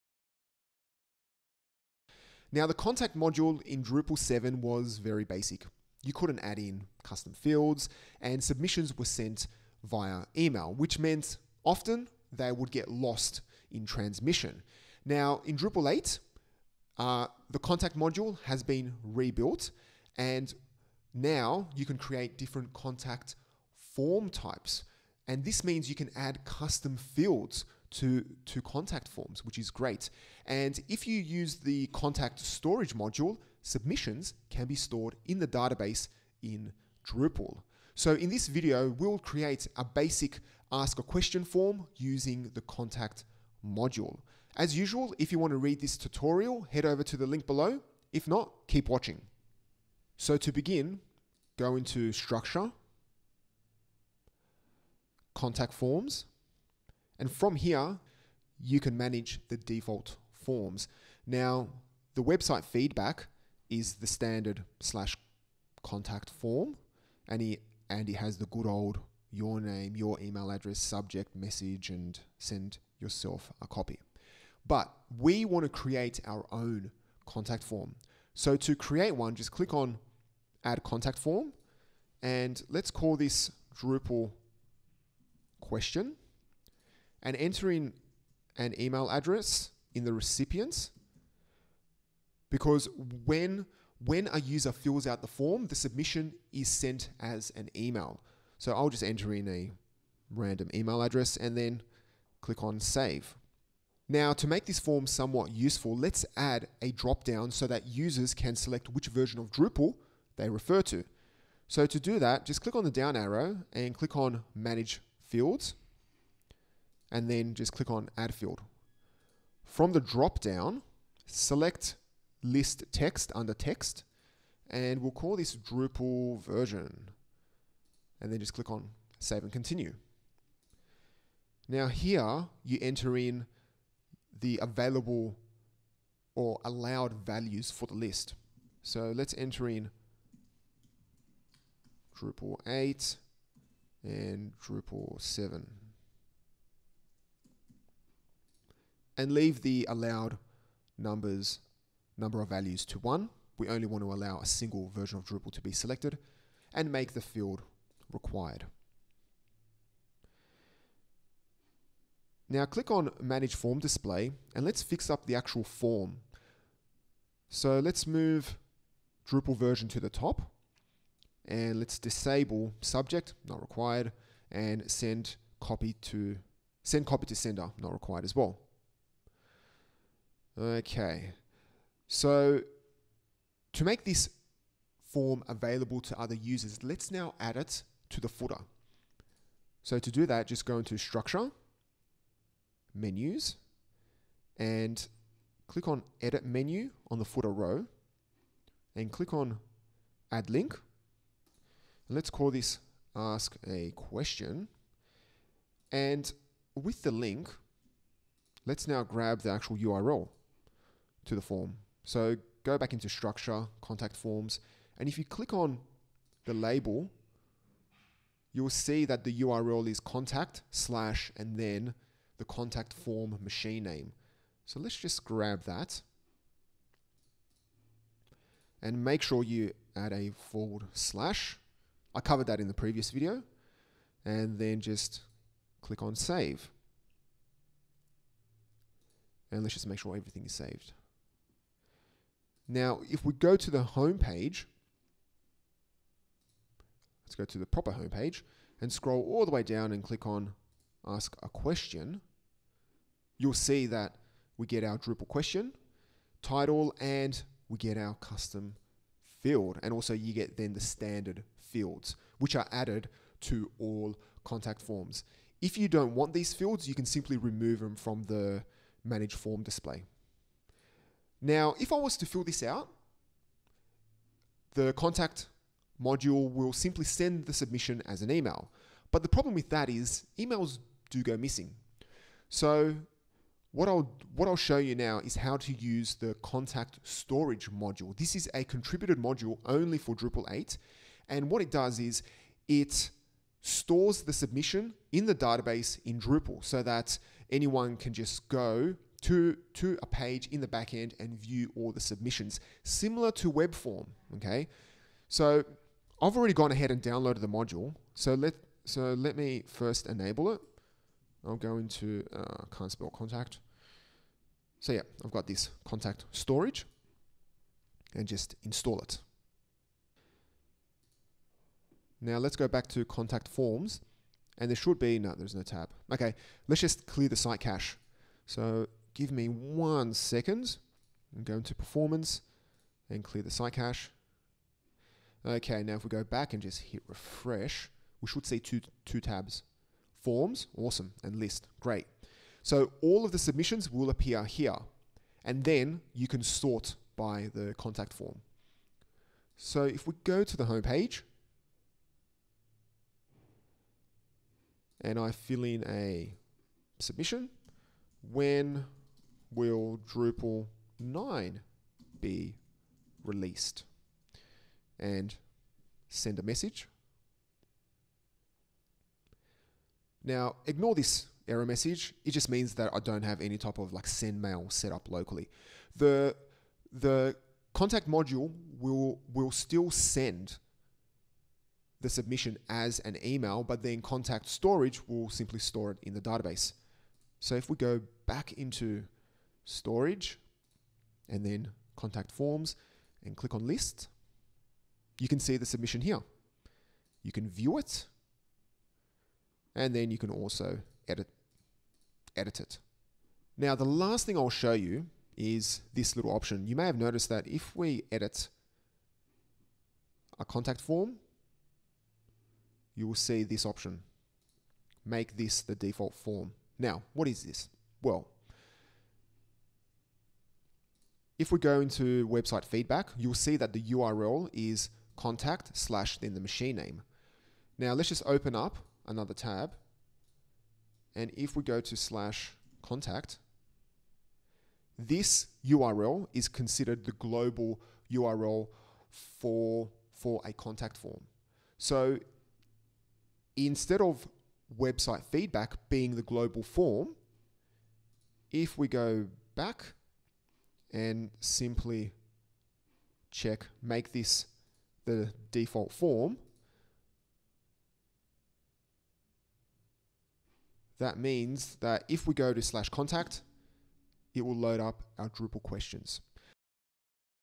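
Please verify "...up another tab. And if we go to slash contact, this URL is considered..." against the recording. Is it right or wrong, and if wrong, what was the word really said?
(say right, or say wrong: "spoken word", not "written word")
right.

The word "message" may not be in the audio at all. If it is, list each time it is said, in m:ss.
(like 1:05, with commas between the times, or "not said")
1:11, 6:06, 6:11.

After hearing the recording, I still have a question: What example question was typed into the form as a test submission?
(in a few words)
When will Drupal 9 be released?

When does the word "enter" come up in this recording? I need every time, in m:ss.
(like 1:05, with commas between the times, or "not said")
1:27, 1:39, 2:12, 2:19.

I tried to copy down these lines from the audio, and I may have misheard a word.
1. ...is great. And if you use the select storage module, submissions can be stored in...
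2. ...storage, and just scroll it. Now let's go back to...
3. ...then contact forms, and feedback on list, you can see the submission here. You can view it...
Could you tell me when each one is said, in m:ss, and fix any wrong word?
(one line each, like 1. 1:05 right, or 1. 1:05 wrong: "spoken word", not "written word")
1. 0:29 wrong: "contact", not "select"
2. 5:16 wrong: "install", not "scroll"
3. 6:31 wrong: "click", not "feedback".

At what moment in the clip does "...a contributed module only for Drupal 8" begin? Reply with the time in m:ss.
4:48.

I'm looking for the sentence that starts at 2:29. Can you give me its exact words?
and leave the allowed numbers number of values to 1.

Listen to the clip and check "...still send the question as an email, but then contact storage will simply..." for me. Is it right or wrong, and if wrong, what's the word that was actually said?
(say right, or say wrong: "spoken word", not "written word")
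wrong: "submission", not "question".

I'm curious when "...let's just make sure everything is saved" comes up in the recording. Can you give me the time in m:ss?
3:59.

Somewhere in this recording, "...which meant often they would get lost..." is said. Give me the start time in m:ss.
0:10.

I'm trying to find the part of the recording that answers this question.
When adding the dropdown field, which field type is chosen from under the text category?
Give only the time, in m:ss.
2:02.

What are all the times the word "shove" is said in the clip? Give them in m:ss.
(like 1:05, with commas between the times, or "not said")
not said.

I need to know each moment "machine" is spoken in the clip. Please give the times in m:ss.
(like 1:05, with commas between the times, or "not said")
3:43, 7:06.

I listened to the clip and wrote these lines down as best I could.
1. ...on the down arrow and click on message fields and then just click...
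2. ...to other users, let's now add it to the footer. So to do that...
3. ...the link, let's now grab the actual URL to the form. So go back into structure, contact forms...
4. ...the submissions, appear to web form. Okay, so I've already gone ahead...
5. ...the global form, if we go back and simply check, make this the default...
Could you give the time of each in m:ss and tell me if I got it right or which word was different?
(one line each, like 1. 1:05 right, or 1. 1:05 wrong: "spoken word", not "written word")
1. 1:52 wrong: "manage", not "message"
2. 3:06 right
3. 3:27 right
4. 5:01 wrong: "similar", not "appear"
5. 7:26 right.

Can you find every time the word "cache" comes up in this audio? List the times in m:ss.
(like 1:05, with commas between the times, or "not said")
5:27, 5:33.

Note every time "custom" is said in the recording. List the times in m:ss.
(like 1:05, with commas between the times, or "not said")
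0:07, 0:26, 4:18.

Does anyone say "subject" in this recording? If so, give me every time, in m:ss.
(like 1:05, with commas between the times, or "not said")
1:10, 2:52.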